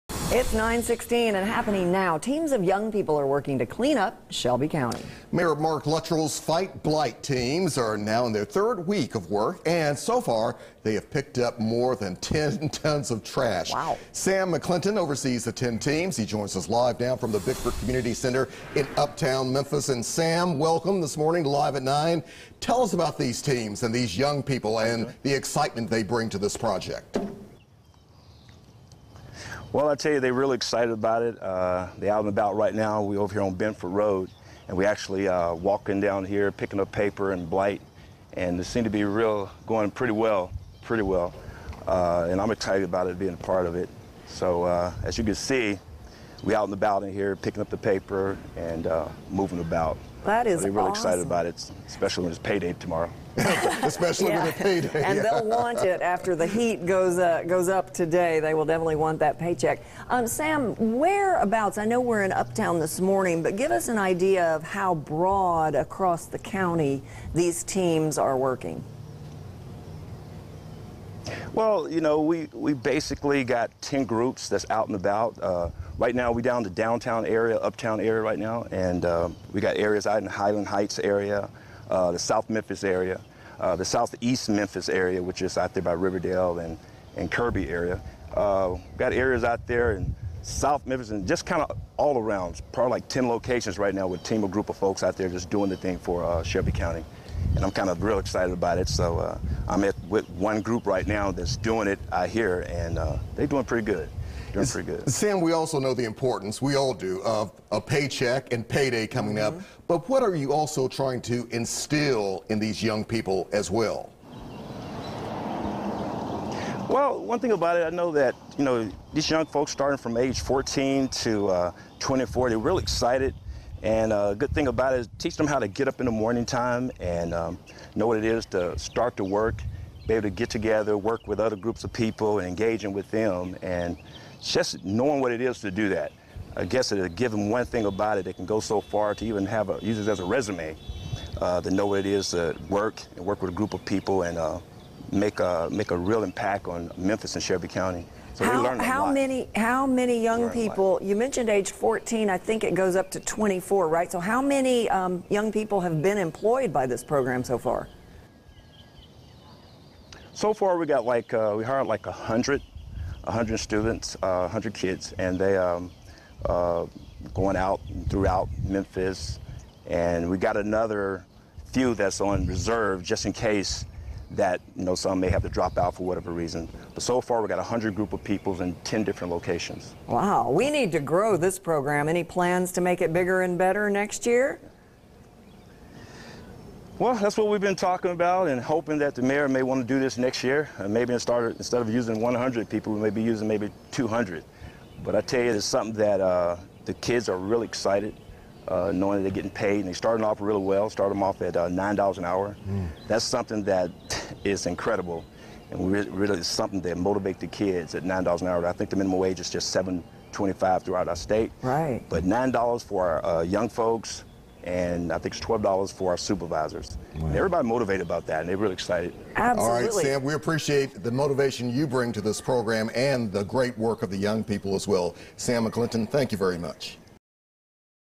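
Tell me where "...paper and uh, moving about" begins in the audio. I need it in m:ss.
0:47.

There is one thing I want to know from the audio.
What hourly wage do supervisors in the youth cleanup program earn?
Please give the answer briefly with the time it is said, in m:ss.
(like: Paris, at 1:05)
$12, at 3:35.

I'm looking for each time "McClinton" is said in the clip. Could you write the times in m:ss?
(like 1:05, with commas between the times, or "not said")
0:14, 3:45.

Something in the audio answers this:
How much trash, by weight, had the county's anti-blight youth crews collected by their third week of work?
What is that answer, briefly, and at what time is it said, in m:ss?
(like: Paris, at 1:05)
more than 10 tons, at 0:11.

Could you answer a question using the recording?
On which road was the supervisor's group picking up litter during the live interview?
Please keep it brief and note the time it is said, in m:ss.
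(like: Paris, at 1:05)
Benford Road, at 0:33.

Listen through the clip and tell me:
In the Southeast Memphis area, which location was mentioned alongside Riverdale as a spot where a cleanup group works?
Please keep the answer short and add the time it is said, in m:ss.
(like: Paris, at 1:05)
Kirby, at 1:27.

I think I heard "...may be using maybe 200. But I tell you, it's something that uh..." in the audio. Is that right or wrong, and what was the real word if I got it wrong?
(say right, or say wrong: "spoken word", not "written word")
right.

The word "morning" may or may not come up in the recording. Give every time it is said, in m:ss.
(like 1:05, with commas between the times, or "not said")
0:21, 1:03, 2:06.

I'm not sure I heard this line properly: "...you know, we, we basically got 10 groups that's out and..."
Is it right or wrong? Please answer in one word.
right.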